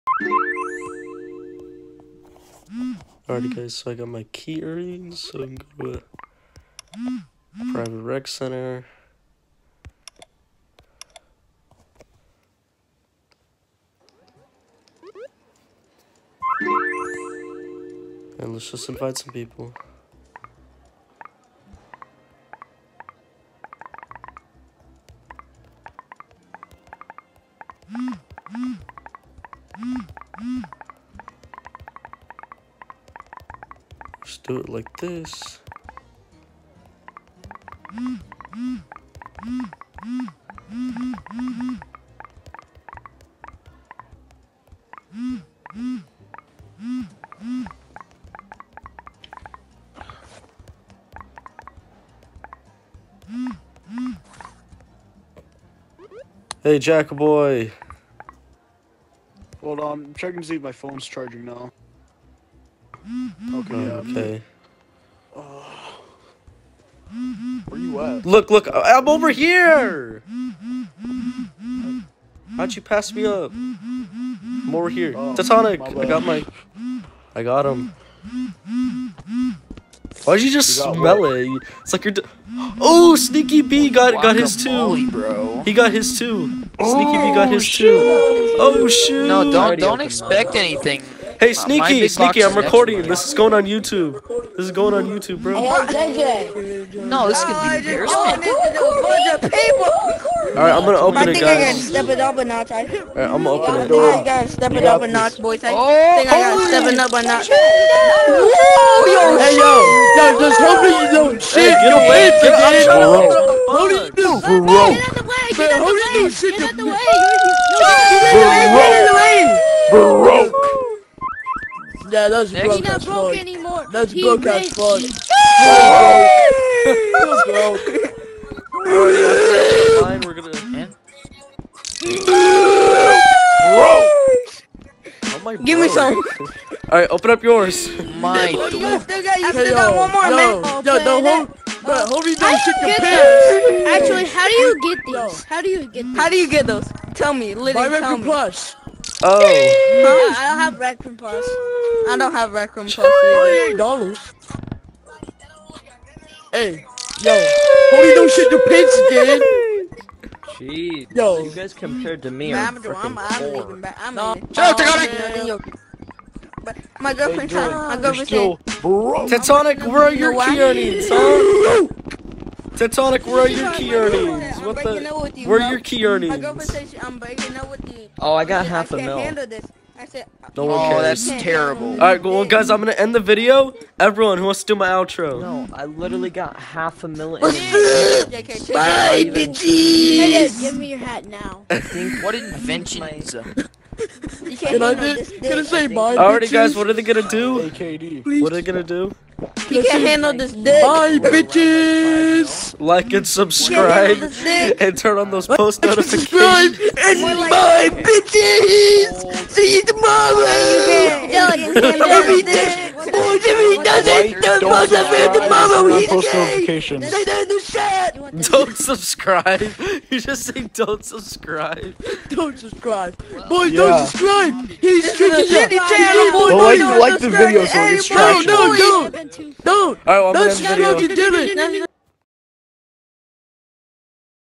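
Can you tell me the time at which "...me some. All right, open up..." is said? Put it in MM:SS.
02:15.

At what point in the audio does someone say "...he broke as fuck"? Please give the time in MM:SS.
02:04.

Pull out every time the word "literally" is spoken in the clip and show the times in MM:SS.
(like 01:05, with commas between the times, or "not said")
02:27, 03:05.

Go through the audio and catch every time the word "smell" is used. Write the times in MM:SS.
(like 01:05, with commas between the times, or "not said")
01:20.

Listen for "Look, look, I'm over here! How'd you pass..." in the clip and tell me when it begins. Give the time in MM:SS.
01:08.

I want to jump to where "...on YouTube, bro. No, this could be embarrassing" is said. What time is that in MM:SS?
01:34.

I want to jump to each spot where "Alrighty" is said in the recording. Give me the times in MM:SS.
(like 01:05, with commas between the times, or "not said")
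00:03, 03:16.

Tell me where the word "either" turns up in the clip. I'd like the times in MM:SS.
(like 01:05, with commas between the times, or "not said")
02:32.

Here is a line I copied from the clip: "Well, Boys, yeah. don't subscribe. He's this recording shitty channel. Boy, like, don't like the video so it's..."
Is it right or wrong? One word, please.
wrong.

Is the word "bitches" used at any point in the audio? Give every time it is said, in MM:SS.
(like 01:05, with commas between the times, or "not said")
03:09, 03:21, 03:27.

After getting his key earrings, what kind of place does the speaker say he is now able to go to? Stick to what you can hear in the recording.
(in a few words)
private rec center.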